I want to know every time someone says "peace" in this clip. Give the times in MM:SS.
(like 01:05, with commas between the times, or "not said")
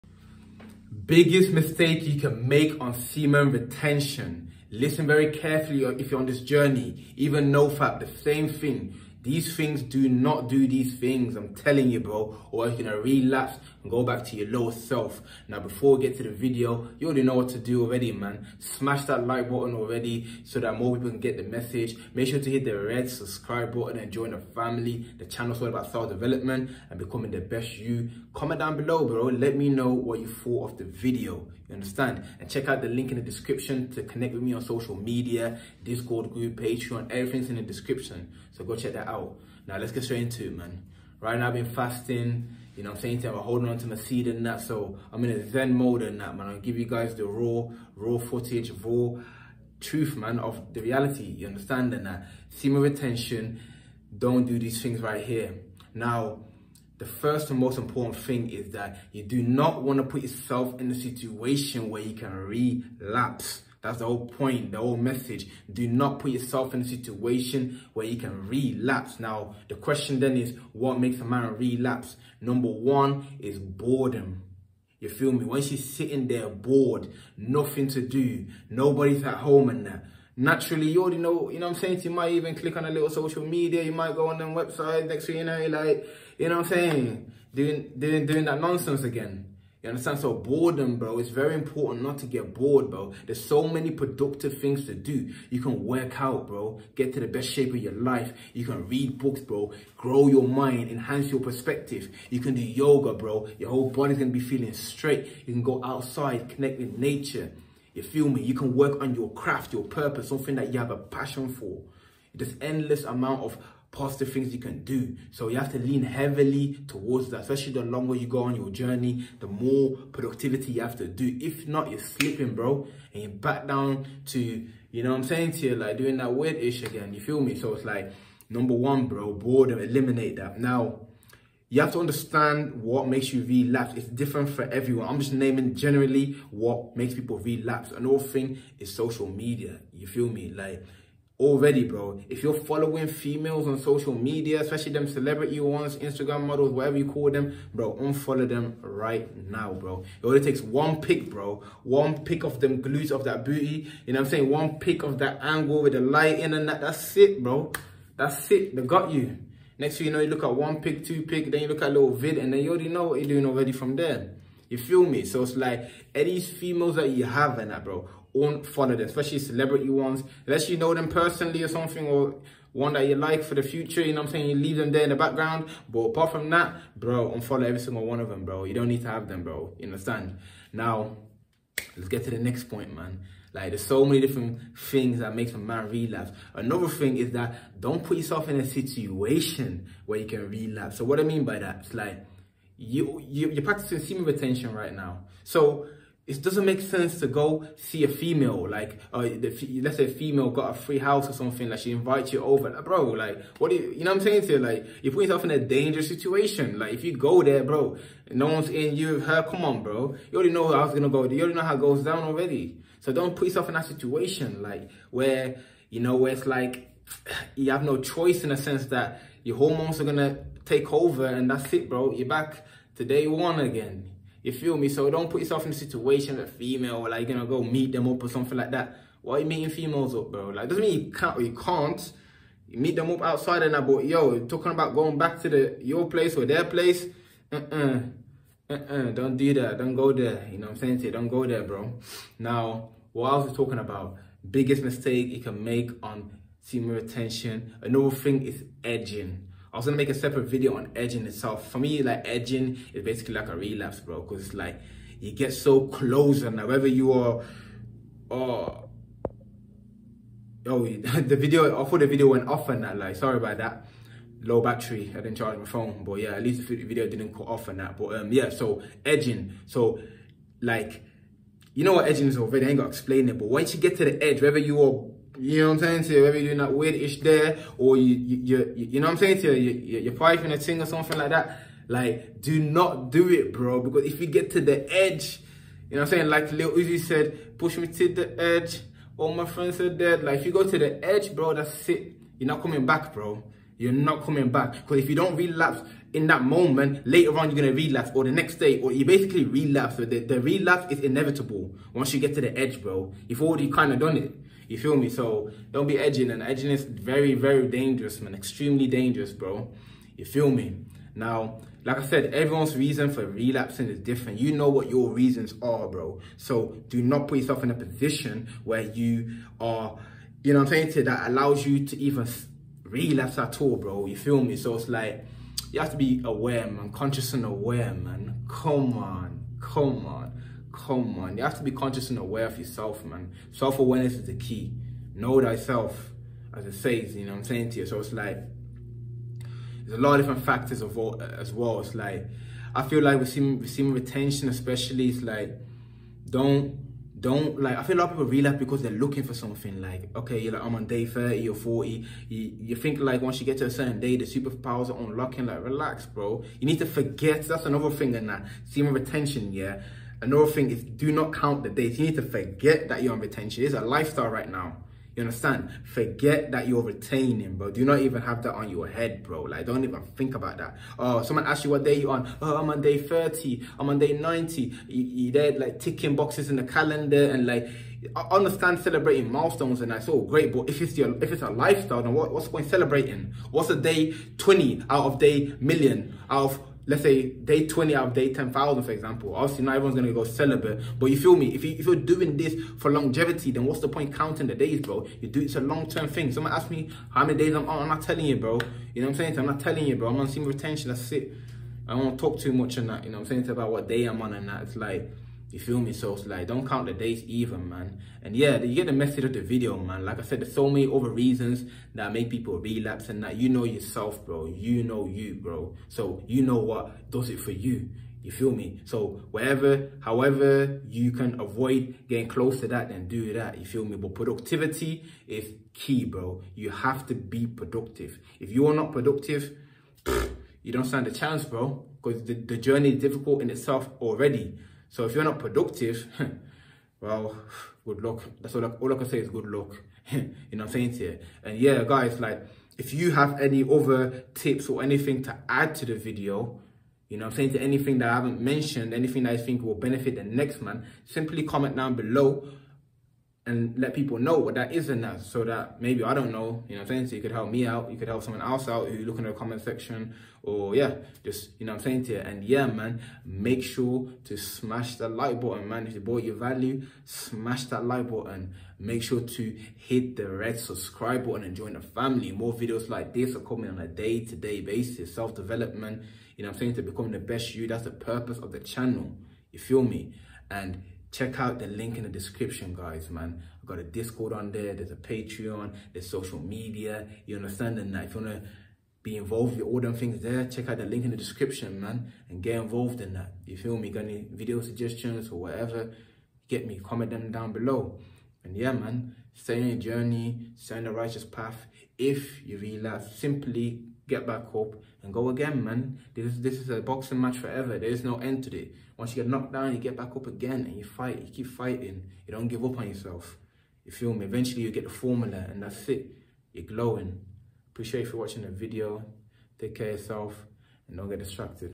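not said.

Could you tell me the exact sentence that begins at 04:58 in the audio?
Or the next day, or you basically relapse.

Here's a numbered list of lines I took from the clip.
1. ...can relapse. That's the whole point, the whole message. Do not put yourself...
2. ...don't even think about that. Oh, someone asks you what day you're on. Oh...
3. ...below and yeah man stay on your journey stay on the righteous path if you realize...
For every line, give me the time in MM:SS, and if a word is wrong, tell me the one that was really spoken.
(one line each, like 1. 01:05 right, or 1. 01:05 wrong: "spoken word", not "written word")
1. 01:02 right
2. 06:09 right
3. 08:17 right.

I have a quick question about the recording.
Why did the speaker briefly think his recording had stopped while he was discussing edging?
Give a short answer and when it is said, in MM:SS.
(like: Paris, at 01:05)
Low battery, at 04:24.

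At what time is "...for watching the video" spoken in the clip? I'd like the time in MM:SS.
08:38.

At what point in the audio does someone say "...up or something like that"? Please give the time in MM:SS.
03:48.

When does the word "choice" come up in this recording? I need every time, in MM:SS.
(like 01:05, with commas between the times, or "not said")
03:37.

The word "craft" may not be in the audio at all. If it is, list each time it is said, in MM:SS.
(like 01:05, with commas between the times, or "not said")
01:49.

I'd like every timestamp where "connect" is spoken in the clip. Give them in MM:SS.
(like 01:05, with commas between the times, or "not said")
00:34, 01:46.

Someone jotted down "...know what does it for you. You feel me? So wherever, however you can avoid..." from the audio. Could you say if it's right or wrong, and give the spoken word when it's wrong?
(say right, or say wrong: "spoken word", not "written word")
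right.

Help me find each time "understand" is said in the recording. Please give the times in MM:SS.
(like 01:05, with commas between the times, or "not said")
00:31, 00:51, 01:29, 02:12, 02:59, 06:05, 06:18, 08:07.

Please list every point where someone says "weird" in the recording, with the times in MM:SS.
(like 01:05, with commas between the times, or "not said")
02:06, 04:36.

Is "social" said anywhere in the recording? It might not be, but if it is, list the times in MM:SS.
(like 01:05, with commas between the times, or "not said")
00:34, 01:23, 02:18, 02:23, 08:06.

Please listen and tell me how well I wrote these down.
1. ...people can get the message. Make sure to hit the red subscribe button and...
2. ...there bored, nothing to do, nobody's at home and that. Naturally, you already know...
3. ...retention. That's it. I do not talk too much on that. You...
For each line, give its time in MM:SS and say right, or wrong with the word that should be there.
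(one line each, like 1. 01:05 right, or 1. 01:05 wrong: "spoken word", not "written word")
1. 00:20 right
2. 01:16 right
3. 06:40 right.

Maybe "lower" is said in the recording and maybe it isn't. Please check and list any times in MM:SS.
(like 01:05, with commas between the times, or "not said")
00:14.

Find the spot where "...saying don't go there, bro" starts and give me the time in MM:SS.
04:00.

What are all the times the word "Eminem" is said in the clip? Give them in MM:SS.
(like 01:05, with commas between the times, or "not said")
not said.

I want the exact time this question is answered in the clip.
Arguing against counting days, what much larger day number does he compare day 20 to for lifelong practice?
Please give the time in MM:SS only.
06:28.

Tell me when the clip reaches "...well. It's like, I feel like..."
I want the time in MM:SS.
05:41.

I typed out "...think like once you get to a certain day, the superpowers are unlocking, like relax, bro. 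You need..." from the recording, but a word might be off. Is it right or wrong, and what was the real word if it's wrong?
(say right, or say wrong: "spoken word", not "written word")
right.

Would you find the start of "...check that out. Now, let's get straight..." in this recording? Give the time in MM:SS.
00:38.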